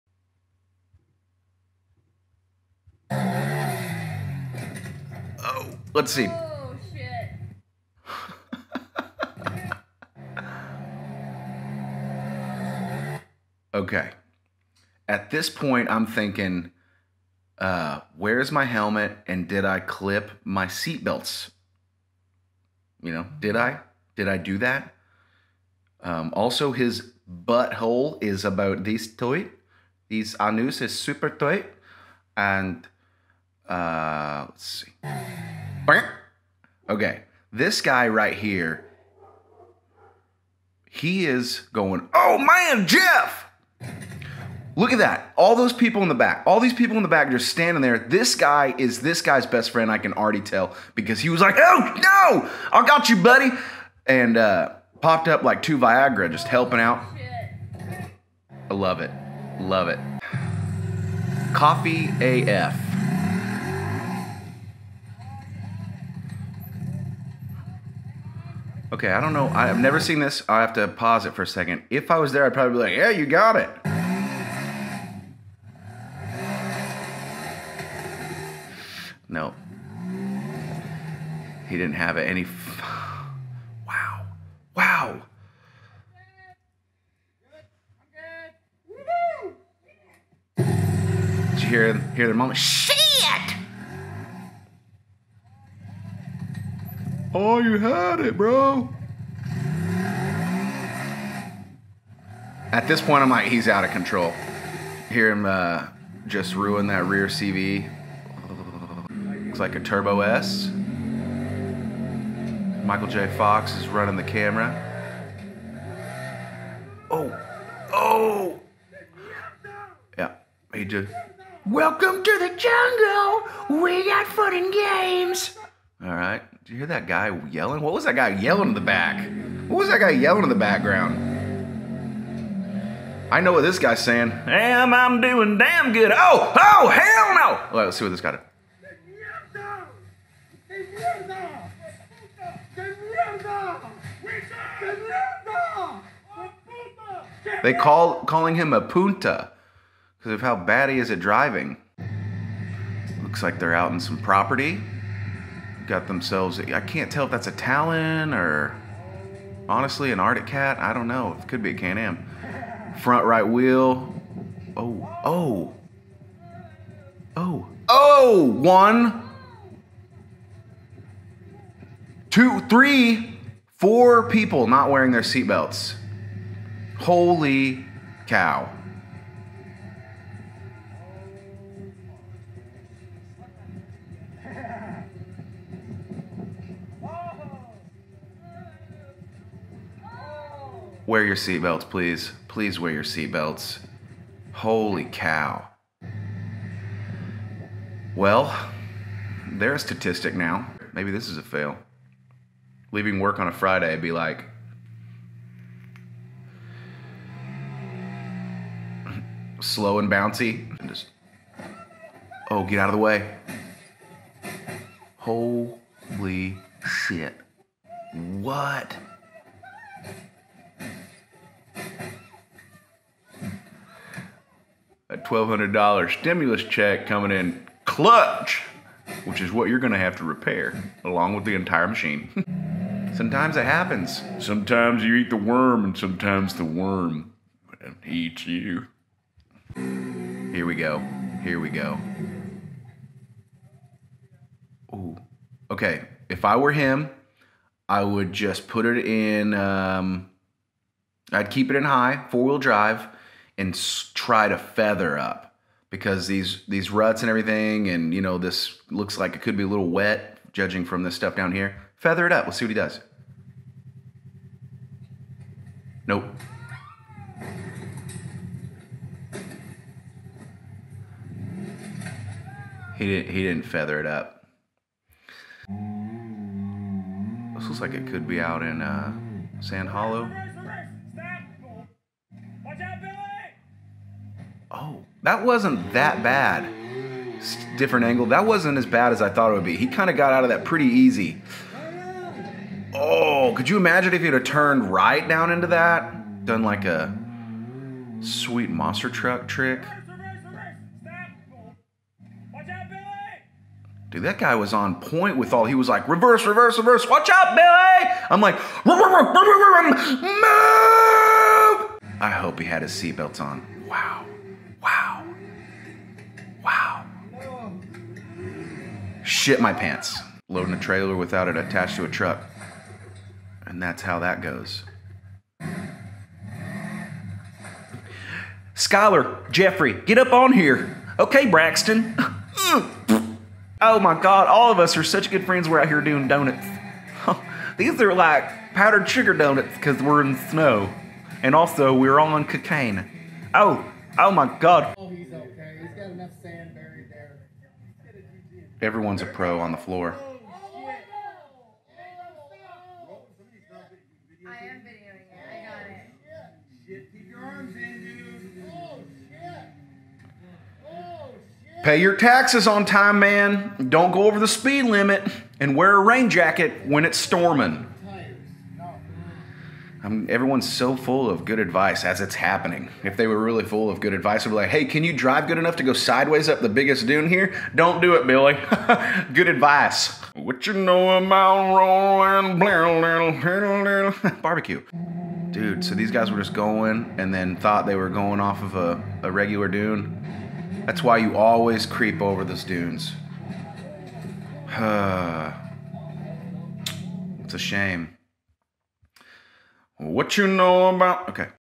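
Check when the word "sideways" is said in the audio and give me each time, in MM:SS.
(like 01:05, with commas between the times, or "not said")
06:15.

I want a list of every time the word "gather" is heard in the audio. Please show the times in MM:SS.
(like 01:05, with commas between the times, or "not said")
not said.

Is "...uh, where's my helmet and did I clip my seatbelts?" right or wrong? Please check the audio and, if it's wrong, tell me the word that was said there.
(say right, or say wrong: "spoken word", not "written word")
right.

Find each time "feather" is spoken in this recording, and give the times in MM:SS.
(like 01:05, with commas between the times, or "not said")
04:14, 04:21, 04:33.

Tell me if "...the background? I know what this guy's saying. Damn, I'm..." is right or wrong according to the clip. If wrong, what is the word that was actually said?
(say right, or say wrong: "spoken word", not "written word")
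right.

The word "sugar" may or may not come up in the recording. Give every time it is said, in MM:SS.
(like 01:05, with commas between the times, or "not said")
05:39.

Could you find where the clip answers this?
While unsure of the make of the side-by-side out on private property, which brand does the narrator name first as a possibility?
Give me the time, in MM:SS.
02:37.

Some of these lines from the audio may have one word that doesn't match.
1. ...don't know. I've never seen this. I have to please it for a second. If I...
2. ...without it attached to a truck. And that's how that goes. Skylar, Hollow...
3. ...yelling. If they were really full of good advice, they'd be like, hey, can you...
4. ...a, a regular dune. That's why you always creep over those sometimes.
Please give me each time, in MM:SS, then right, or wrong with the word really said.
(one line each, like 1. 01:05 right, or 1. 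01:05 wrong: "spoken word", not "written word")
1. 01:09 wrong: "pause", not "please"
2. 05:21 wrong: "Jeffrey", not "Hollow"
3. 06:12 wrong: "happening", not "yelling"
4. 06:28 wrong: "dunes", not "sometimes".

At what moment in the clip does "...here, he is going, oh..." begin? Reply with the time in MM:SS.
00:38.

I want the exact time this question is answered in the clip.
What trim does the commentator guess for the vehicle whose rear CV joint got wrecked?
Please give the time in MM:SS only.
01:49.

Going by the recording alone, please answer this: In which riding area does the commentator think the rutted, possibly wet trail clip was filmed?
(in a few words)
Sand Hollow.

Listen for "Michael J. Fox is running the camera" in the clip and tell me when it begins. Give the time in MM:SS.
01:52.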